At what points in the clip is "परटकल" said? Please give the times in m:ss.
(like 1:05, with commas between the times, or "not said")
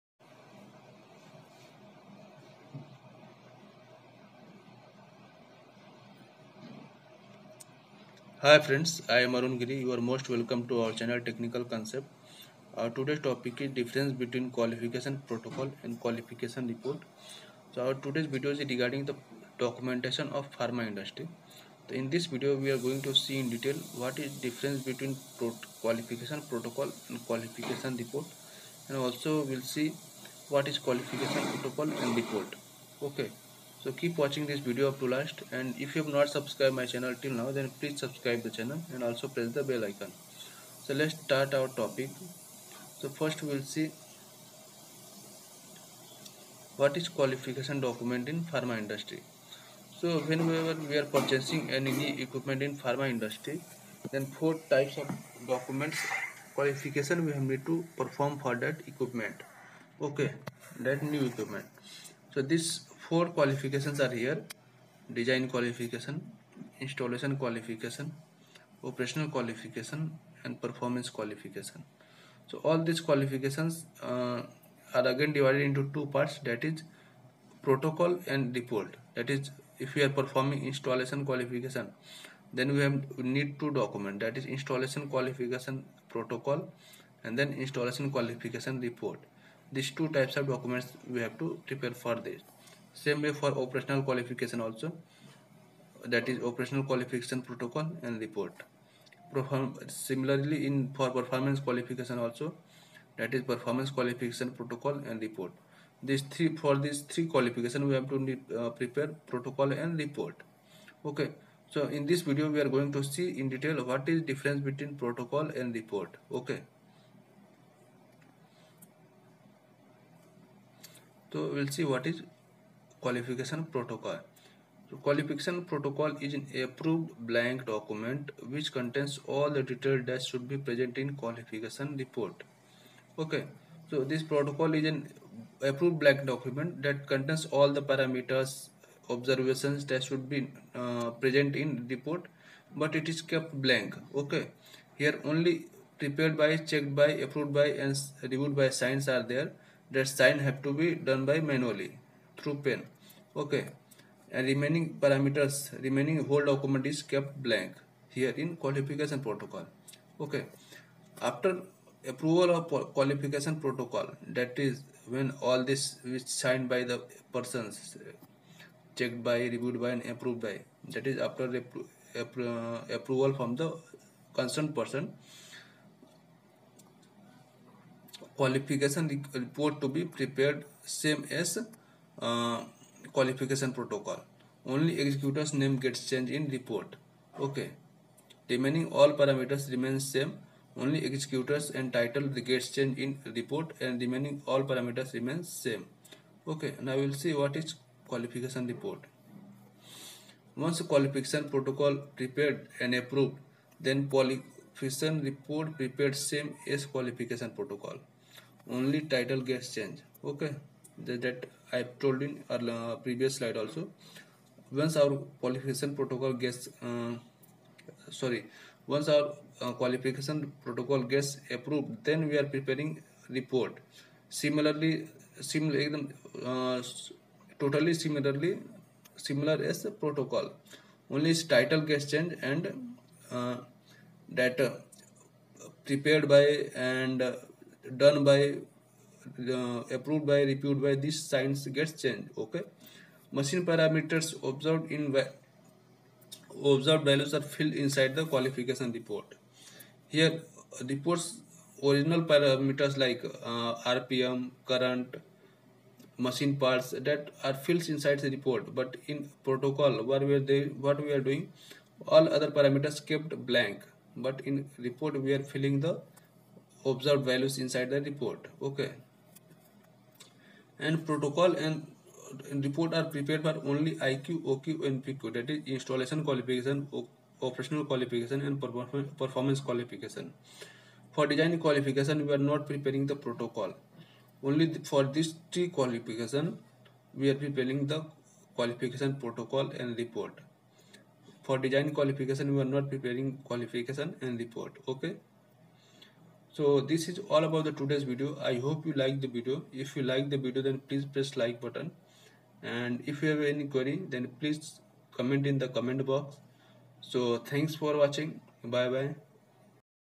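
3:03, 3:21, 3:27.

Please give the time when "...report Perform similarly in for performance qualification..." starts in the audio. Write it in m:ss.
1:38.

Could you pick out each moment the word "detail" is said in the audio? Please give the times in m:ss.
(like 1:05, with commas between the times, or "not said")
0:23, 1:53, 2:09.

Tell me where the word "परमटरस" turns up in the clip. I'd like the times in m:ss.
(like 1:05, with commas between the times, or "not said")
3:09, 3:14.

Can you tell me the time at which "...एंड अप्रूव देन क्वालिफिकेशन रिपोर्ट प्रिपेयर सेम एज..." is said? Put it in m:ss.
3:22.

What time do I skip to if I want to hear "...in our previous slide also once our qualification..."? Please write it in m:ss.
3:32.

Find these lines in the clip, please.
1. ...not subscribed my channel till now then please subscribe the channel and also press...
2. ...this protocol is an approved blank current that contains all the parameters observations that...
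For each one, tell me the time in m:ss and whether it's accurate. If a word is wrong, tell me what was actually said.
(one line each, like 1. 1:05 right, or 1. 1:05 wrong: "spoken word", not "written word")
1. 0:36 right
2. 2:14 wrong: "document", not "current".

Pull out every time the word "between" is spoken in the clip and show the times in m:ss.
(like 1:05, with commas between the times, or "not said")
0:14, 0:24, 1:54.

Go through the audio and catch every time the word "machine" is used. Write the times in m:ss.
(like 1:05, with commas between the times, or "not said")
4:03, 4:16.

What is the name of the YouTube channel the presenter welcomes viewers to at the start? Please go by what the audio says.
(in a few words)
Technical Concept.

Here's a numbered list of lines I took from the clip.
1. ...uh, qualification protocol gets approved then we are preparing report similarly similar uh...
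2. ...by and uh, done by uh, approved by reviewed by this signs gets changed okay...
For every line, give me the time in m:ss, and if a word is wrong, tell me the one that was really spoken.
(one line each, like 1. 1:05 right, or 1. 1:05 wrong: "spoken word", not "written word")
1. 3:39 right
2. 3:56 right.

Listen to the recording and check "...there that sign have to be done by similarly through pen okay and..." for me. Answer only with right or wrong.
wrong.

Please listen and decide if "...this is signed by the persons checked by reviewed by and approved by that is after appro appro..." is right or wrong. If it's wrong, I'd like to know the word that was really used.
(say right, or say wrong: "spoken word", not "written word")
right.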